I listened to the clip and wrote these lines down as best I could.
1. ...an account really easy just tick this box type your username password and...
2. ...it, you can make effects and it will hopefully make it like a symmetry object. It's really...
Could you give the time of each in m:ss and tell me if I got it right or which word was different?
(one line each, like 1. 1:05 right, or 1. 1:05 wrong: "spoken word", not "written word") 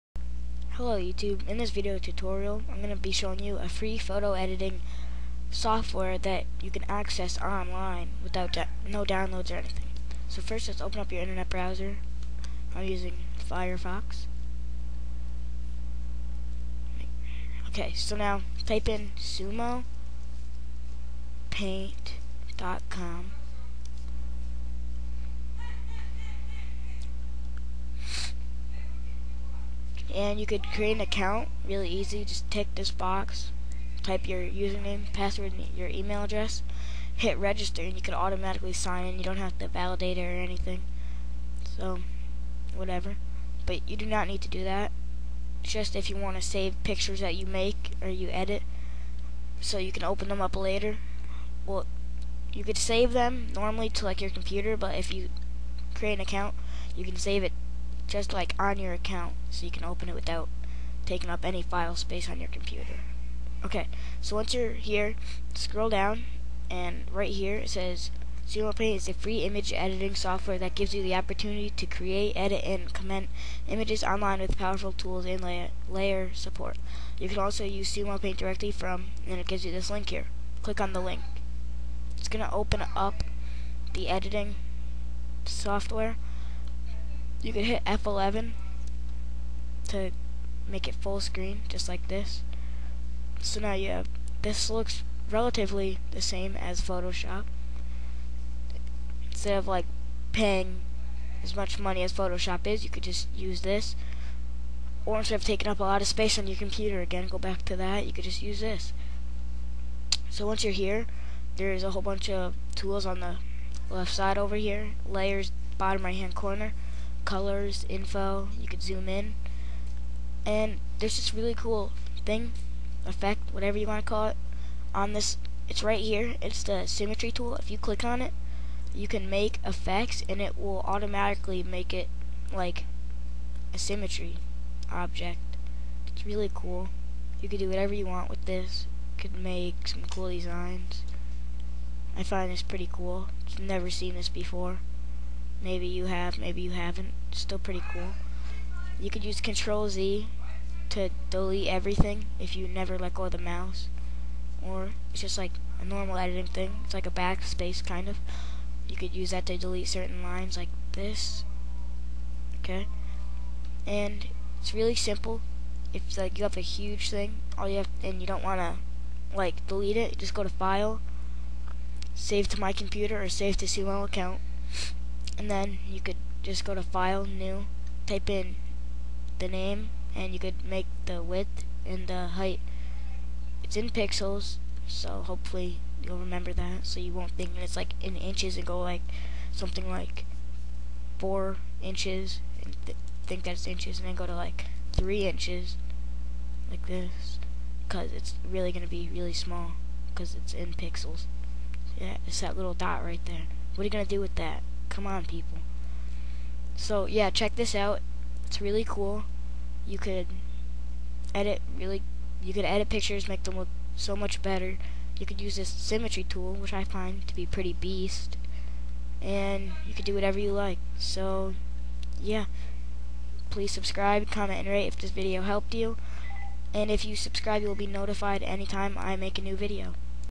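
1. 0:30 right
2. 2:08 wrong: "automatically", not "hopefully".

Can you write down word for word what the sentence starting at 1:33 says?
So now you have, this looks relatively the same as Photoshop.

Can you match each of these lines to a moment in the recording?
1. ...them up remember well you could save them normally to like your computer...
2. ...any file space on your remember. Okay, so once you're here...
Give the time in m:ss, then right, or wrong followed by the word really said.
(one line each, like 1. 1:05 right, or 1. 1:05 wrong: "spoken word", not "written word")
1. 0:50 wrong: "later", not "remember"
2. 1:01 wrong: "computer", not "remember".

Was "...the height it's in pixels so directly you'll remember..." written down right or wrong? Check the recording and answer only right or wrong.
wrong.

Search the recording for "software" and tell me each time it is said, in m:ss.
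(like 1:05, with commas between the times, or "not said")
0:05, 1:10, 1:25.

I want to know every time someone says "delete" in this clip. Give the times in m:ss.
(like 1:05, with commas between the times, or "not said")
2:31, 2:39, 2:49.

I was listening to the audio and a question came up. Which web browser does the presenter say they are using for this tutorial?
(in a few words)
Firefox.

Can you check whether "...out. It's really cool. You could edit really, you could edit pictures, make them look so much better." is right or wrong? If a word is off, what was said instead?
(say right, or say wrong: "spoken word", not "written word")
right.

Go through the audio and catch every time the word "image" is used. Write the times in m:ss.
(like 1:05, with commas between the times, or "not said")
1:09, 1:13.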